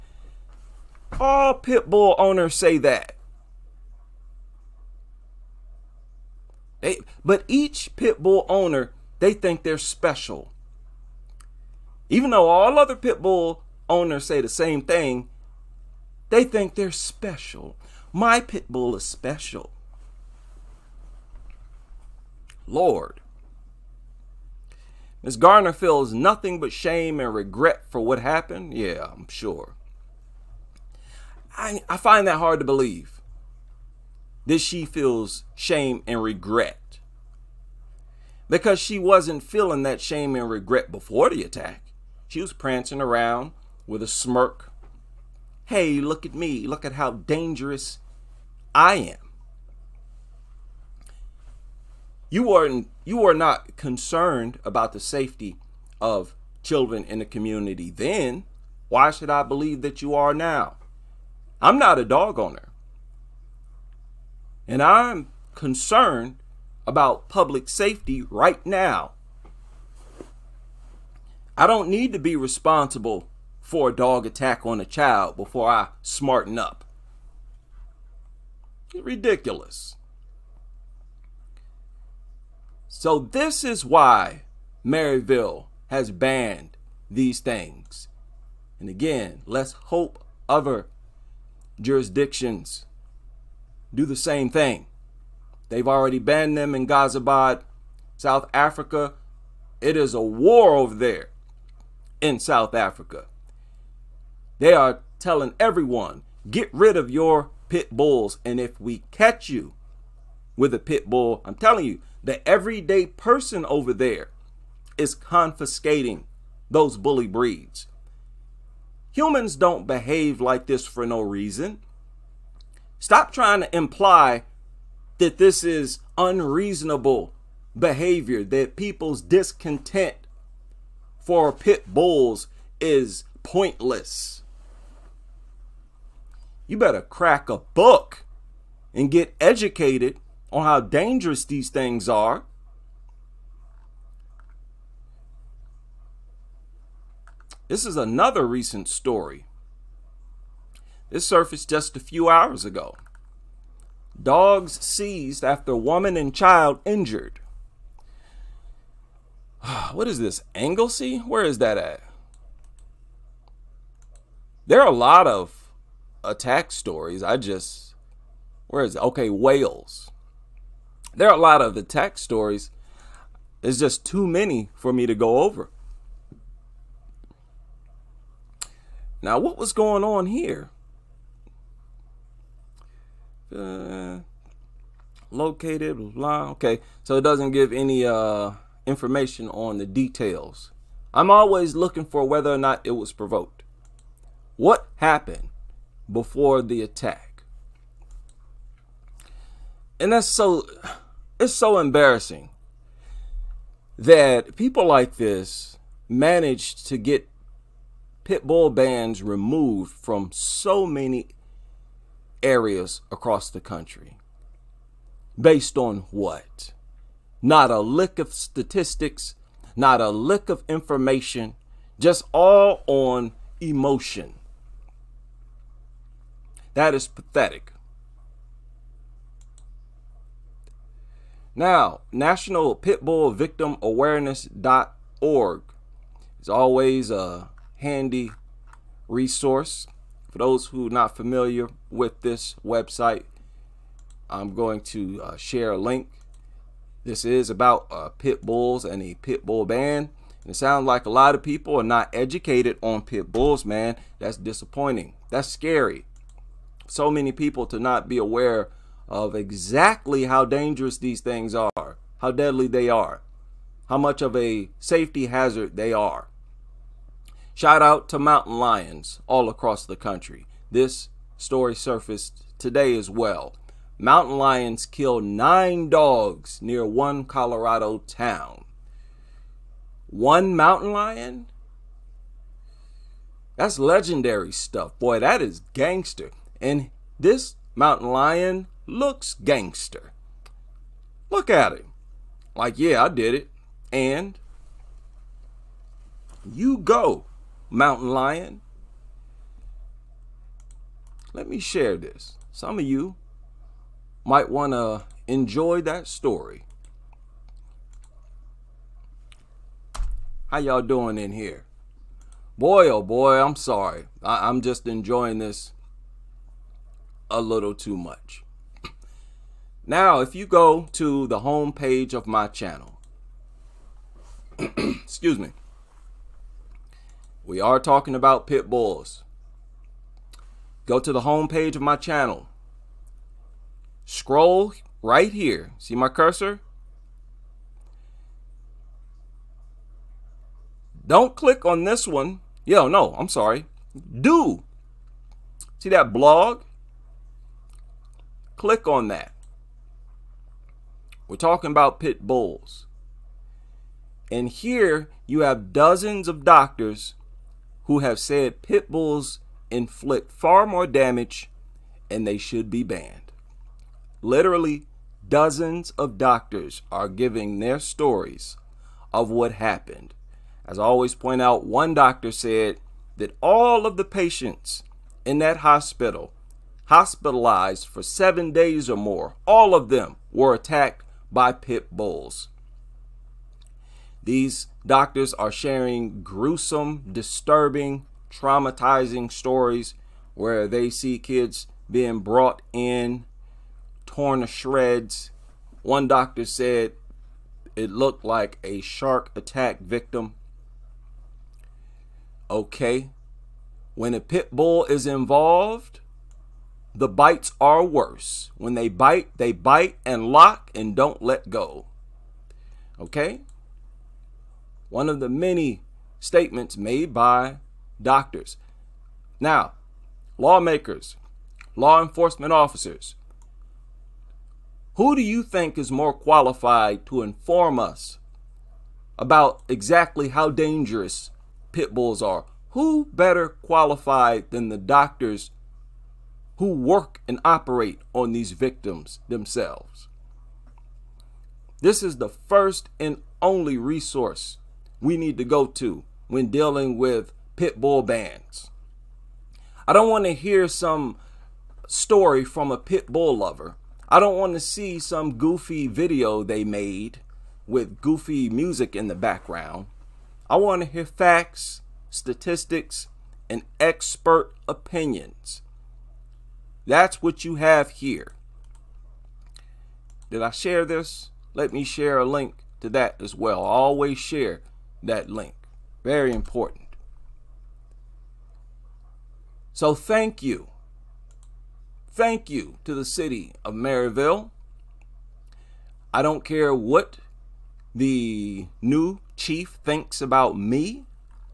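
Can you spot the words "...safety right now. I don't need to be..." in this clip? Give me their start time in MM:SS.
01:07.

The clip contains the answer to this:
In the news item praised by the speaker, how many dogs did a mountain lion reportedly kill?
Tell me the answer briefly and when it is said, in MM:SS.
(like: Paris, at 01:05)
9, at 04:35.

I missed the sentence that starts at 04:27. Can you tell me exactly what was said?
Shout out to mountain lions all across the country.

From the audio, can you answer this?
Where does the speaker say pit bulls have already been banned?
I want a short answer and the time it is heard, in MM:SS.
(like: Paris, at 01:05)
Ghaziabad, at 01:36.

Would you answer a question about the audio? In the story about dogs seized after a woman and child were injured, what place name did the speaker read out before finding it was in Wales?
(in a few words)
Anglesey.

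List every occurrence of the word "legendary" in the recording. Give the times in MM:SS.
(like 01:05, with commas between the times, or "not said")
04:43.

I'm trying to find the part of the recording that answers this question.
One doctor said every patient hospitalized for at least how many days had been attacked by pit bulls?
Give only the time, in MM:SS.
06:18.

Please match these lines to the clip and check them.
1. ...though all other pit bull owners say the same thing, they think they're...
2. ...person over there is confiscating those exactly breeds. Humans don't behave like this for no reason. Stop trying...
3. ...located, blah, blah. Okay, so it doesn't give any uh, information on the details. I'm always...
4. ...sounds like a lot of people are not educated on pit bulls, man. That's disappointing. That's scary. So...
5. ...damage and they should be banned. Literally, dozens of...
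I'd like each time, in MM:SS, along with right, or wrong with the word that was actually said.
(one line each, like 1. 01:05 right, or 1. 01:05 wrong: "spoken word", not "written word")
1. 00:12 right
2. 01:53 wrong: "bully", not "exactly"
3. 03:05 right
4. 04:10 right
5. 06:00 right.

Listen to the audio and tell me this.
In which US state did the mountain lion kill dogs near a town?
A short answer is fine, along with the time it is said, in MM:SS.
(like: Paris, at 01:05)
Colorado, at 04:37.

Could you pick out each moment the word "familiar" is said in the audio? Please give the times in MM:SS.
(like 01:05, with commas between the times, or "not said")
04:01.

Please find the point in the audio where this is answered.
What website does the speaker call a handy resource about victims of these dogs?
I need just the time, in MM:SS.
03:52.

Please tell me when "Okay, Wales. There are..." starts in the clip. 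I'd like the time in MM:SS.
02:49.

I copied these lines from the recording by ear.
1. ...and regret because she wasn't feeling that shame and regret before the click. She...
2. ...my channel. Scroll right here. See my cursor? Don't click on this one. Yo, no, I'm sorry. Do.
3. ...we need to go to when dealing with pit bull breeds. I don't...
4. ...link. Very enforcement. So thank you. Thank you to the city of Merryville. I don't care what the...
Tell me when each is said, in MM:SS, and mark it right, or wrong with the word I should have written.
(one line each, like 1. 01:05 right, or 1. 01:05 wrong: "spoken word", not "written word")
1. 00:36 wrong: "attack", not "click"
2. 05:31 right
3. 07:25 wrong: "bands", not "breeds"
4. 07:55 wrong: "important", not "enforcement".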